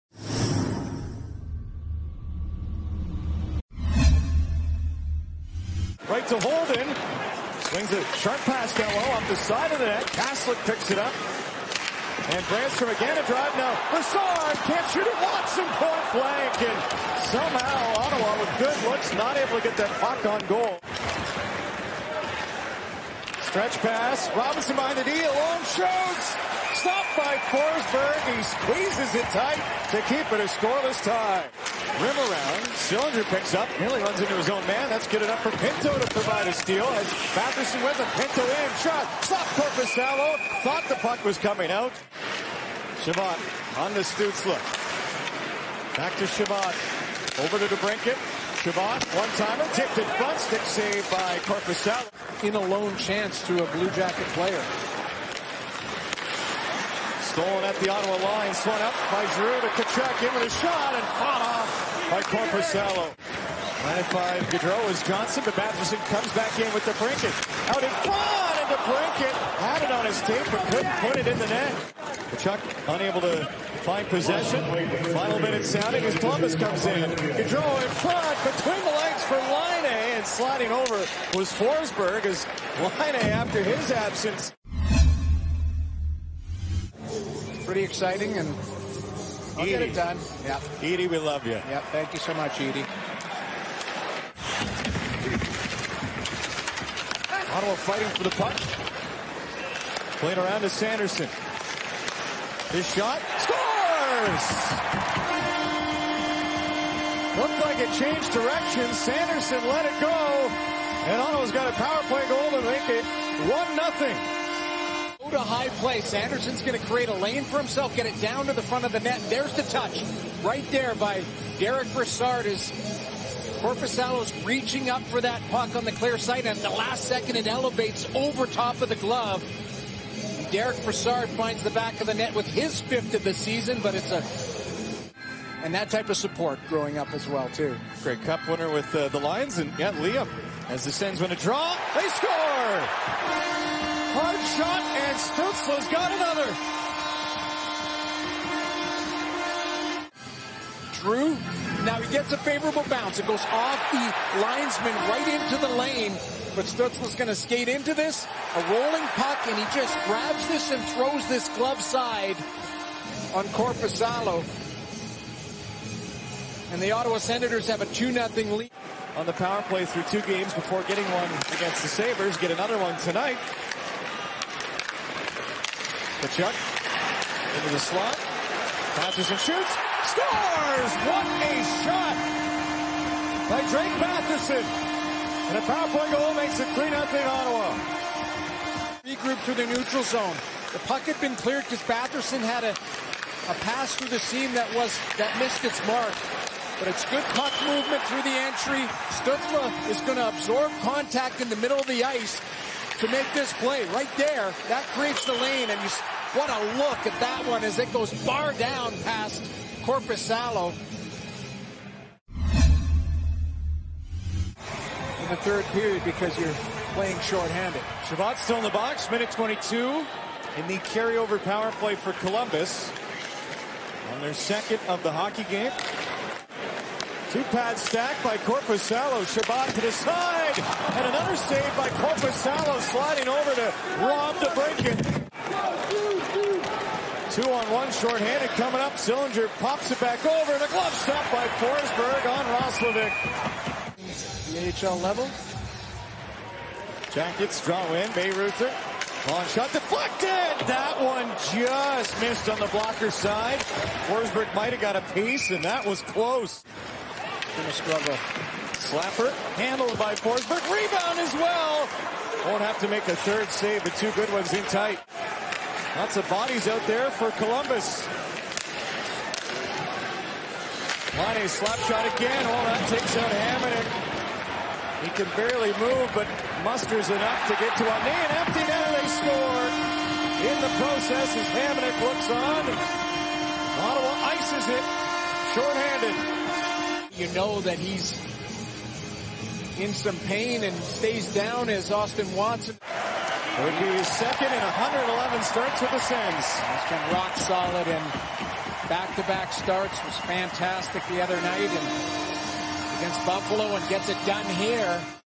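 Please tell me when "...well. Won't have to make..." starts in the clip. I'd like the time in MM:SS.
04:21.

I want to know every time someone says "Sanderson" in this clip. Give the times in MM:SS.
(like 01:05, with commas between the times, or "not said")
01:40, 01:48.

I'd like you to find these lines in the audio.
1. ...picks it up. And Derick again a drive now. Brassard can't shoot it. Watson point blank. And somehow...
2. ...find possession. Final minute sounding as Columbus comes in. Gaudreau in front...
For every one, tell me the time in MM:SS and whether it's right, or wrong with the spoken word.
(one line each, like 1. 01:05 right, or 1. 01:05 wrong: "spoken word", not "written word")
1. 00:10 wrong: "Brännström", not "Derick"
2. 01:13 right.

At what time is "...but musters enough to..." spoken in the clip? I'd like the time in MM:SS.
04:36.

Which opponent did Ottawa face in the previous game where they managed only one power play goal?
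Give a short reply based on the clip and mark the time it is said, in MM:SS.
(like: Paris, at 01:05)
Sabres, at 02:51.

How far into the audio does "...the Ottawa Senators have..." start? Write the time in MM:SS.
02:46.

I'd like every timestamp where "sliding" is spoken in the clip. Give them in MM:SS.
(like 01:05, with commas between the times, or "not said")
01:20, 03:52.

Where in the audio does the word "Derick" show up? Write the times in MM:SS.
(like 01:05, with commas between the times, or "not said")
02:01, 02:10.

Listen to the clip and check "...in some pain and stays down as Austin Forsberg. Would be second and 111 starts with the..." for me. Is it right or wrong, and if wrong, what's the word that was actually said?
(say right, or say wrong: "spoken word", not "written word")
wrong: "Watson", not "Forsberg".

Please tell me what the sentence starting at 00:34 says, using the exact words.
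That's good enough for Pinto to provide a steal as Batherson with a Pinto in.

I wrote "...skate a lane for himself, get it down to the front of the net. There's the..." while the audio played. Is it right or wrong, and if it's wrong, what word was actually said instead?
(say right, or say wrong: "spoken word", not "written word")
wrong: "create", not "skate".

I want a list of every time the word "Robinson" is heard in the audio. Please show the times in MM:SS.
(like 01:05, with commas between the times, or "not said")
00:24.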